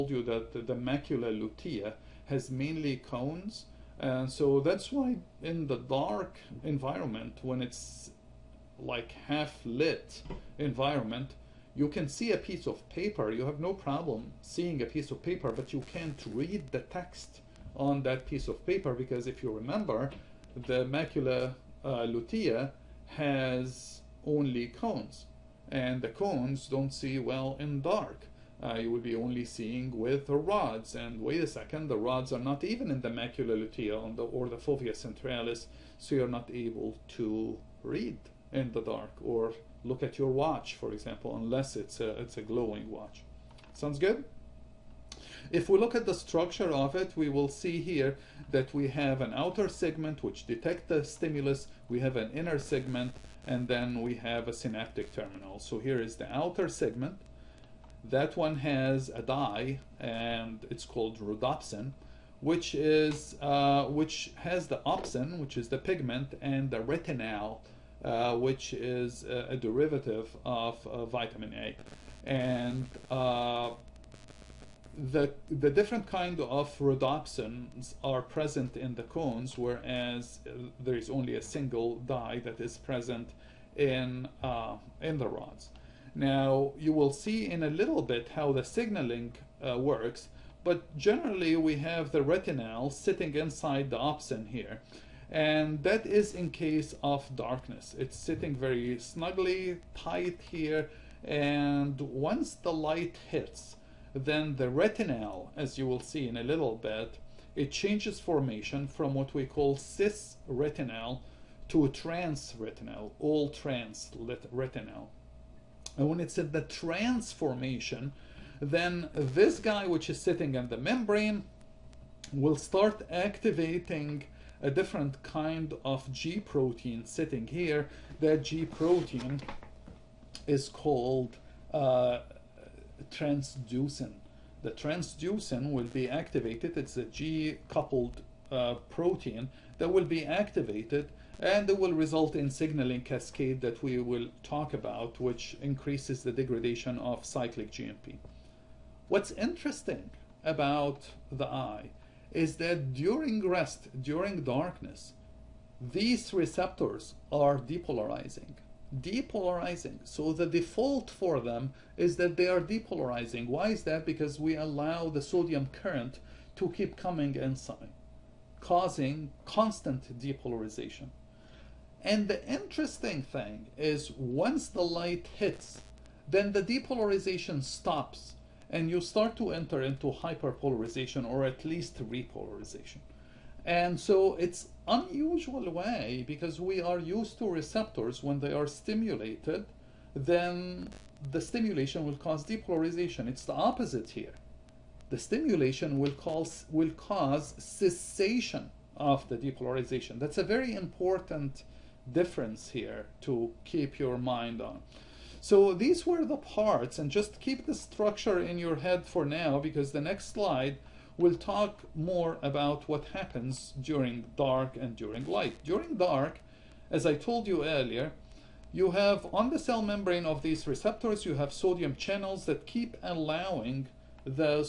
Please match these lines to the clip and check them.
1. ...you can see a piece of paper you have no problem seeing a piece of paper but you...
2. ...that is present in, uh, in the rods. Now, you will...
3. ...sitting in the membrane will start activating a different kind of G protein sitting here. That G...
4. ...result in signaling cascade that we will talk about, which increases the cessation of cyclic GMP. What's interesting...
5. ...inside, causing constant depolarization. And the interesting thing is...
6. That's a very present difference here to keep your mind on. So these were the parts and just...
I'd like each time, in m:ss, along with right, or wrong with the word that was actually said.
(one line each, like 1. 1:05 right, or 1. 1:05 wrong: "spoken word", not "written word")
1. 0:11 right
2. 1:22 right
3. 2:00 right
4. 2:21 wrong: "degradation", not "cessation"
5. 2:47 right
6. 3:20 wrong: "important", not "present".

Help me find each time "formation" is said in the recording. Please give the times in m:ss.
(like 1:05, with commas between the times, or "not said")
1:48, 1:57.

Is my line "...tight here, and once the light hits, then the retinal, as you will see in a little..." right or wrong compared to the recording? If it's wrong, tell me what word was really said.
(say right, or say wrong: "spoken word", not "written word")
right.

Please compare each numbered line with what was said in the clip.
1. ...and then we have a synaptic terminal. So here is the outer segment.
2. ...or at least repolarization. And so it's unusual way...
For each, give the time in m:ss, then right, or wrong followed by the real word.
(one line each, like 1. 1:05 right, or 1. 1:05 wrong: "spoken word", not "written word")
1. 0:53 right
2. 3:01 right.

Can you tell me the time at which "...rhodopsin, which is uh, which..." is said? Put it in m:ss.
1:01.